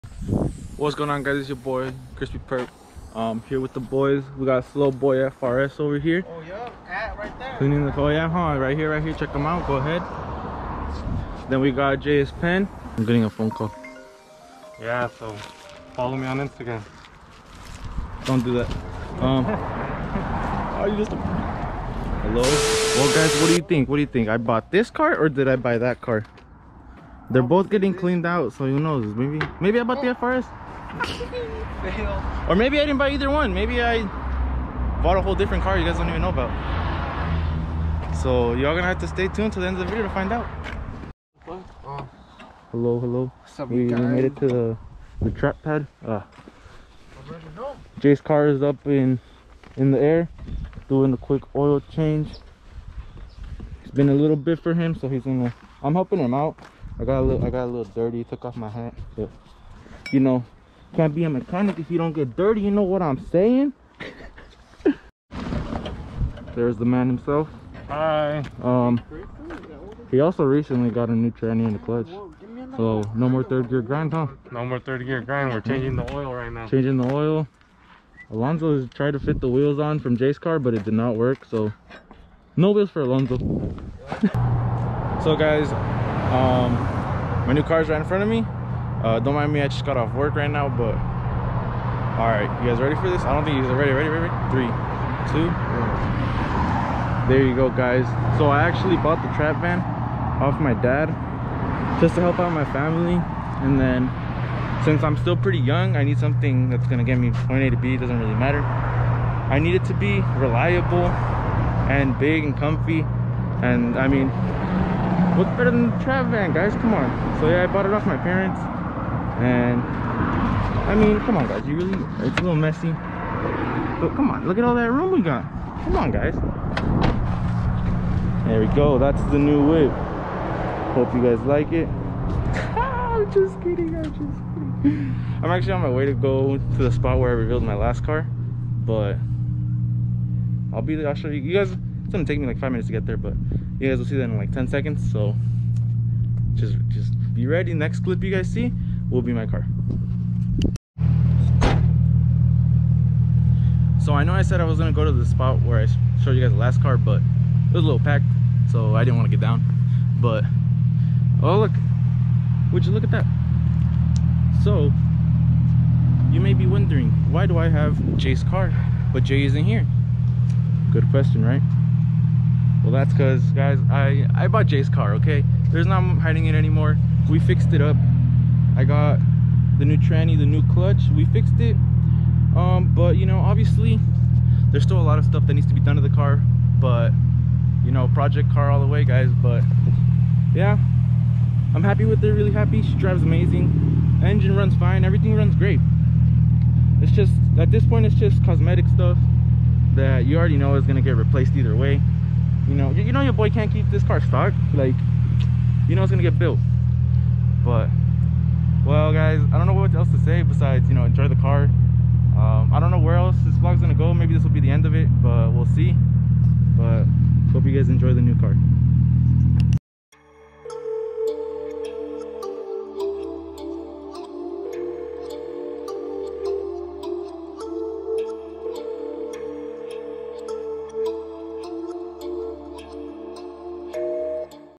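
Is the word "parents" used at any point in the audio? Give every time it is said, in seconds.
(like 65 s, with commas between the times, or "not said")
118 s.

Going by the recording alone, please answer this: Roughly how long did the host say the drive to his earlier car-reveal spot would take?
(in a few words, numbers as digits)
5 minutes.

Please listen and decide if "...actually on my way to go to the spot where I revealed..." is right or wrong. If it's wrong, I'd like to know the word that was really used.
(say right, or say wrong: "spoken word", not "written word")
right.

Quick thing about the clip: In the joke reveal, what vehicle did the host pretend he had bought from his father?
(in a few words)
The trap van.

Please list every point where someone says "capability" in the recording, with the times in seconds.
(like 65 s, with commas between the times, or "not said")
not said.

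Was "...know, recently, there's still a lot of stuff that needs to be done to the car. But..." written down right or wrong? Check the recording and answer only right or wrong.
wrong.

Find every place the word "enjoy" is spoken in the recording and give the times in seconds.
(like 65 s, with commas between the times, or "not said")
211 s, 217 s.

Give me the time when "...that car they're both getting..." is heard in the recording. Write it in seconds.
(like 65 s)
25 s.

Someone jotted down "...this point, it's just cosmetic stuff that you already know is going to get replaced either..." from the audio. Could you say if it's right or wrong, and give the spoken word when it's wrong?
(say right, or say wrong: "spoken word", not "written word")
right.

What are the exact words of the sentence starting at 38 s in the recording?
So y'all gonna have to stay tuned to the end of the video to find out.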